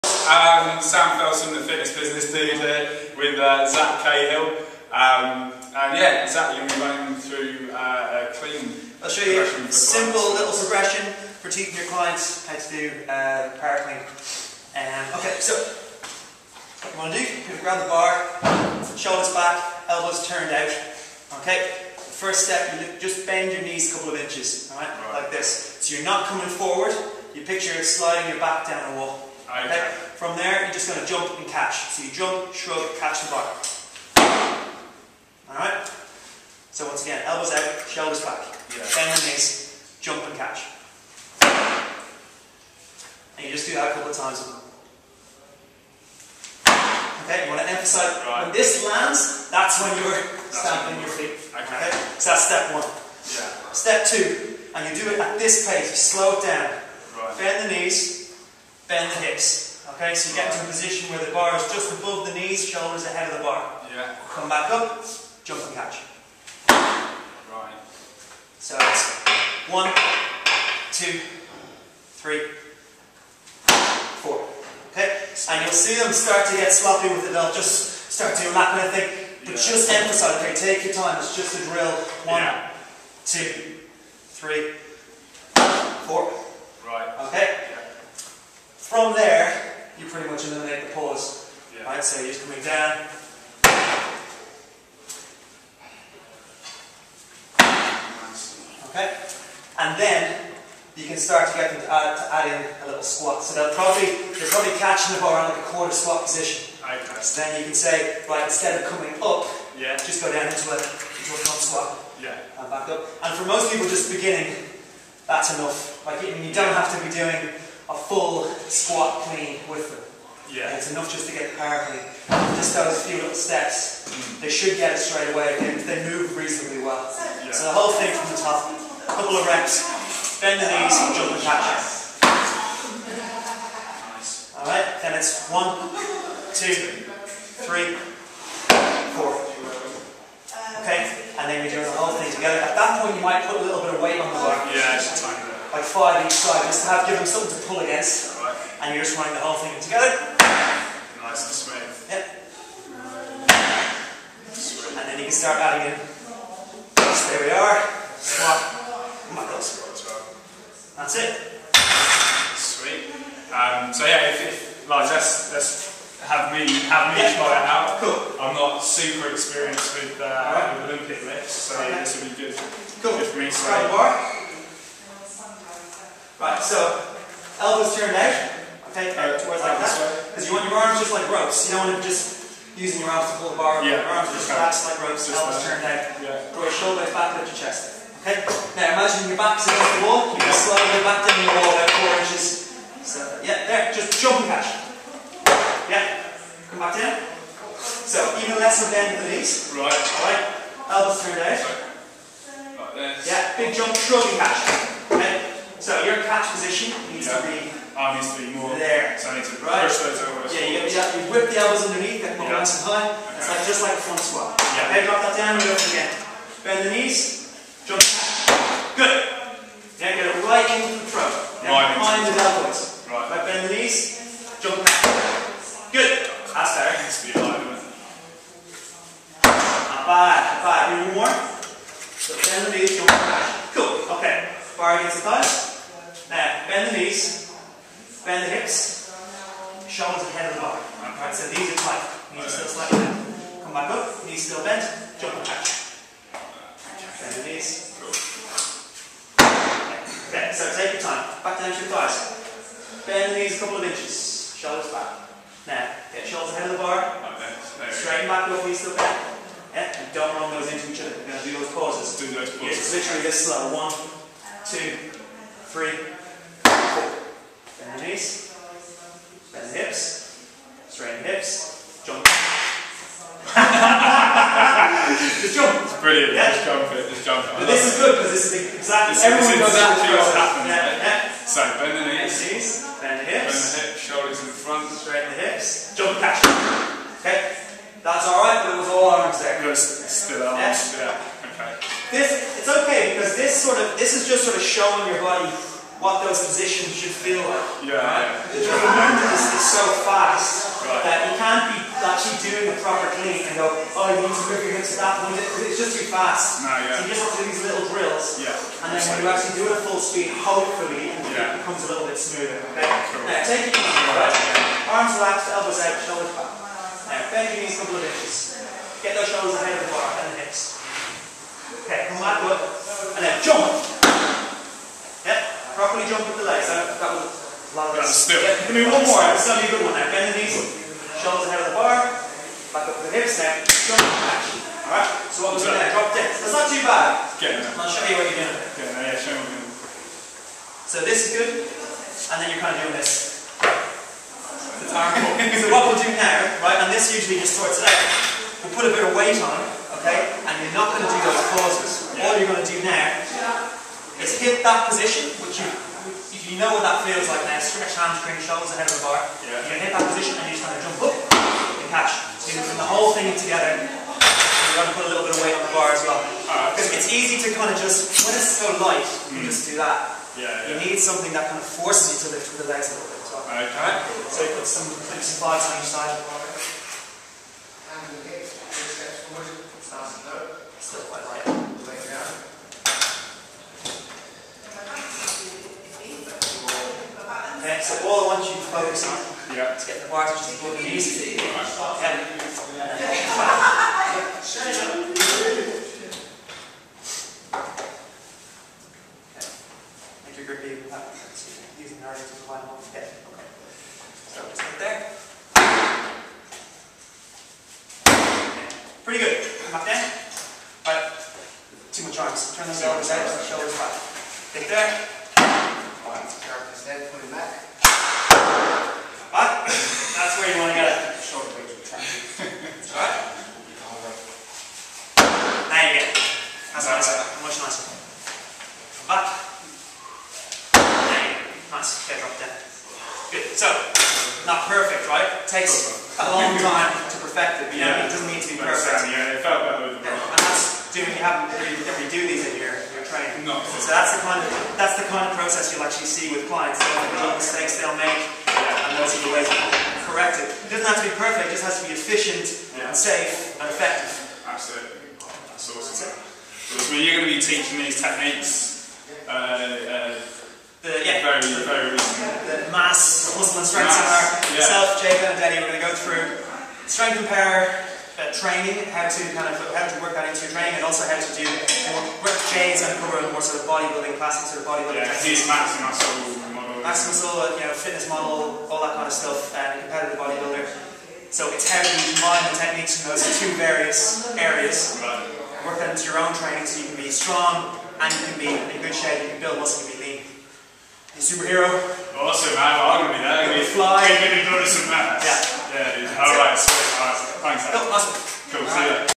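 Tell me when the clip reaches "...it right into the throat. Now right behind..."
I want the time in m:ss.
3:40.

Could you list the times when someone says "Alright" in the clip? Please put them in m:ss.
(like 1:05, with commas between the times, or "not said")
0:35, 2:14, 3:19, 5:34.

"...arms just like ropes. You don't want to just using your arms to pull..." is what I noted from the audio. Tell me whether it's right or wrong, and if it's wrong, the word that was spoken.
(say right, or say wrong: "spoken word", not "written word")
right.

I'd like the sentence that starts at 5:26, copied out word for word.
That, that was a lot of That's still.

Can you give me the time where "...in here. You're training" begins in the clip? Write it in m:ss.
7:22.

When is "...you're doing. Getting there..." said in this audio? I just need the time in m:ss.
5:38.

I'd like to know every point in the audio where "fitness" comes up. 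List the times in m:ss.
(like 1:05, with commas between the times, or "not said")
0:01, 7:57.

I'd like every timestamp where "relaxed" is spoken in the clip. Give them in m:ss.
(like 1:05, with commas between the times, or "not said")
3:04, 5:15.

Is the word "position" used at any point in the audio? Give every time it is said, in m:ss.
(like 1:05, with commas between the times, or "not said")
1:00, 1:46, 3:26, 4:56, 5:54, 6:00.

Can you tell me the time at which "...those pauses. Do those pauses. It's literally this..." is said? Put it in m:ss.
4:21.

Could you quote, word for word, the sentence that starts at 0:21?
Okay, first step, you just bend your knees a couple of inches, all right?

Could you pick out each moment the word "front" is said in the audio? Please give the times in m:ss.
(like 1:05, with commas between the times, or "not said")
1:51, 3:34, 4:44.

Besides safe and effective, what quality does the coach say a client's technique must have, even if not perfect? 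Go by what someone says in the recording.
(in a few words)
Efficient.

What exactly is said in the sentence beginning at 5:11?
it becomes a little bit smoother.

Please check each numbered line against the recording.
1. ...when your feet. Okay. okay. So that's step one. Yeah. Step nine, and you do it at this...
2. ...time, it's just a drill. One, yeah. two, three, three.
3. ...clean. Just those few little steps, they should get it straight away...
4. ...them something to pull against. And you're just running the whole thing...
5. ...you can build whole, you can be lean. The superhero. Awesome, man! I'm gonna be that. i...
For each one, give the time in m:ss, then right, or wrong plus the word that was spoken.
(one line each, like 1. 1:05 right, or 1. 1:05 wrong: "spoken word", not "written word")
1. 0:51 wrong: "two", not "nine"
2. 1:20 wrong: "four", not "three"
3. 2:01 right
4. 2:27 right
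5. 8:09 wrong: "muscle", not "whole".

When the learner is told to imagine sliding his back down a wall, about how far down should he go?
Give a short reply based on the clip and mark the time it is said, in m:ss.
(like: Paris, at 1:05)
About 4 inches, at 3:11.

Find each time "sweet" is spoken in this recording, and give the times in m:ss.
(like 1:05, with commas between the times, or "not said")
2:34, 2:42, 8:16.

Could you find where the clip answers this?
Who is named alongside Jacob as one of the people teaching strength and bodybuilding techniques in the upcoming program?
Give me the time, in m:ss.
7:45.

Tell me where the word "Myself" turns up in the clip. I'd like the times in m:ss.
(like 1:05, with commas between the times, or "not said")
7:44.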